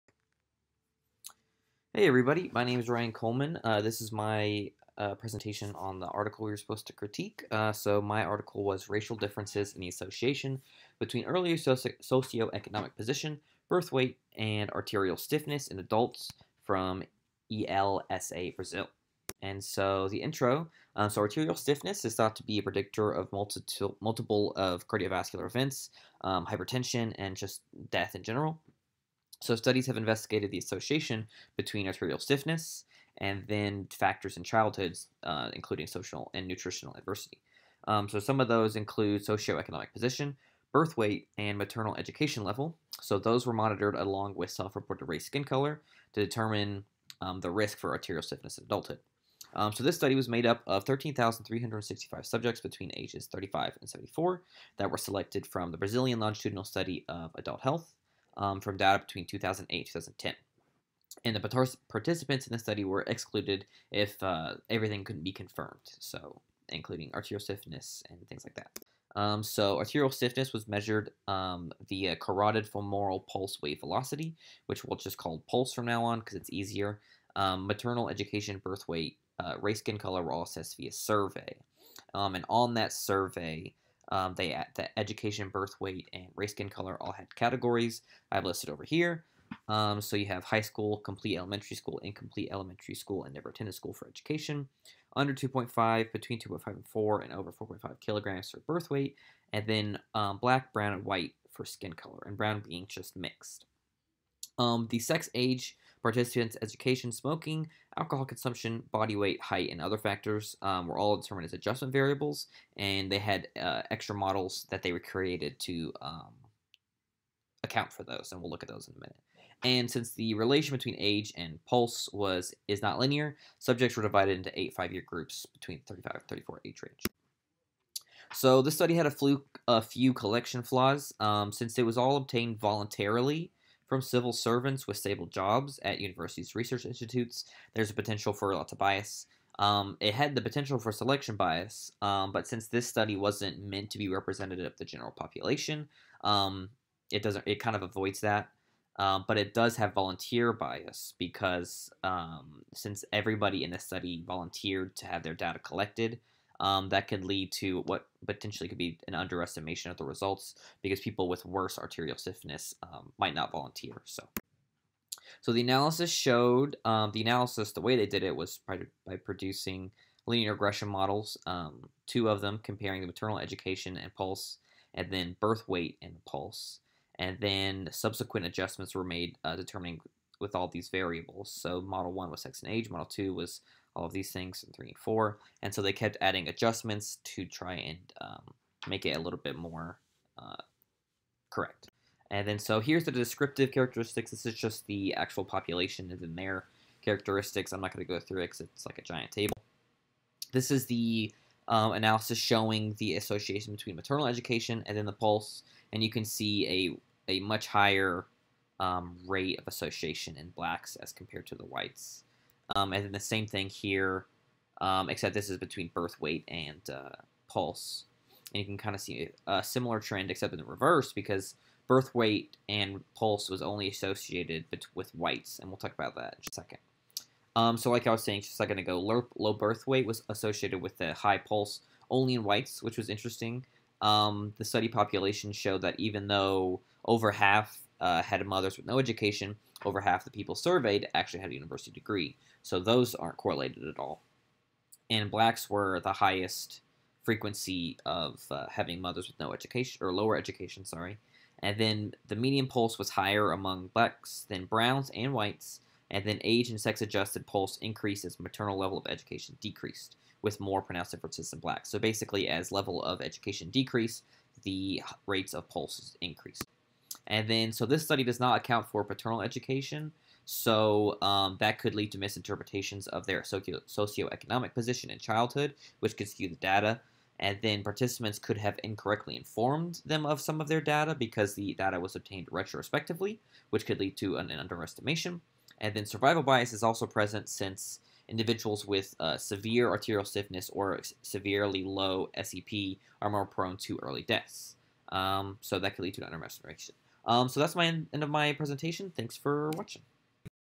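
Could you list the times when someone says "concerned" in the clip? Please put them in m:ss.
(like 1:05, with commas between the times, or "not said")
not said.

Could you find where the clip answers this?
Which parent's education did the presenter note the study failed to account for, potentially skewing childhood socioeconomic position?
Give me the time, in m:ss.
4:29.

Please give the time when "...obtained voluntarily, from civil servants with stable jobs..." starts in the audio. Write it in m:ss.
2:12.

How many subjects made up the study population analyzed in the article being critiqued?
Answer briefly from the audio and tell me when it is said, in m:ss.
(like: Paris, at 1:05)
13,365, at 0:50.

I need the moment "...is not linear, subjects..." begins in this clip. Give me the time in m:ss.
2:02.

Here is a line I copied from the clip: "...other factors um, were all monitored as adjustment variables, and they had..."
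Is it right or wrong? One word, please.
wrong.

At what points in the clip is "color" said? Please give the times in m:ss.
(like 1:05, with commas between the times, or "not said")
0:45, 1:19, 1:26, 1:41.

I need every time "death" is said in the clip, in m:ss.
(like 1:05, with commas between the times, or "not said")
0:27, 4:54.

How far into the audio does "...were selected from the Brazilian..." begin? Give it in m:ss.
0:54.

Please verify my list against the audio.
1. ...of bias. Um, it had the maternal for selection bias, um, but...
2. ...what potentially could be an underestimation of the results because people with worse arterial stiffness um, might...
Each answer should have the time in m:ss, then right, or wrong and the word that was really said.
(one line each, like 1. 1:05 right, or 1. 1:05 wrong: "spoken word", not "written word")
1. 2:18 wrong: "potential", not "maternal"
2. 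2:37 right.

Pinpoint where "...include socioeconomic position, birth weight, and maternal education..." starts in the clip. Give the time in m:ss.
0:38.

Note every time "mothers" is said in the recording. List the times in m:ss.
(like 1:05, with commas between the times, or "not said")
3:58, 4:08.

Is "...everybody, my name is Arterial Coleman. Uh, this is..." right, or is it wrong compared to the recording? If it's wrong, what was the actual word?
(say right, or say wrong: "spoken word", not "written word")
wrong: "Ryan", not "Arterial".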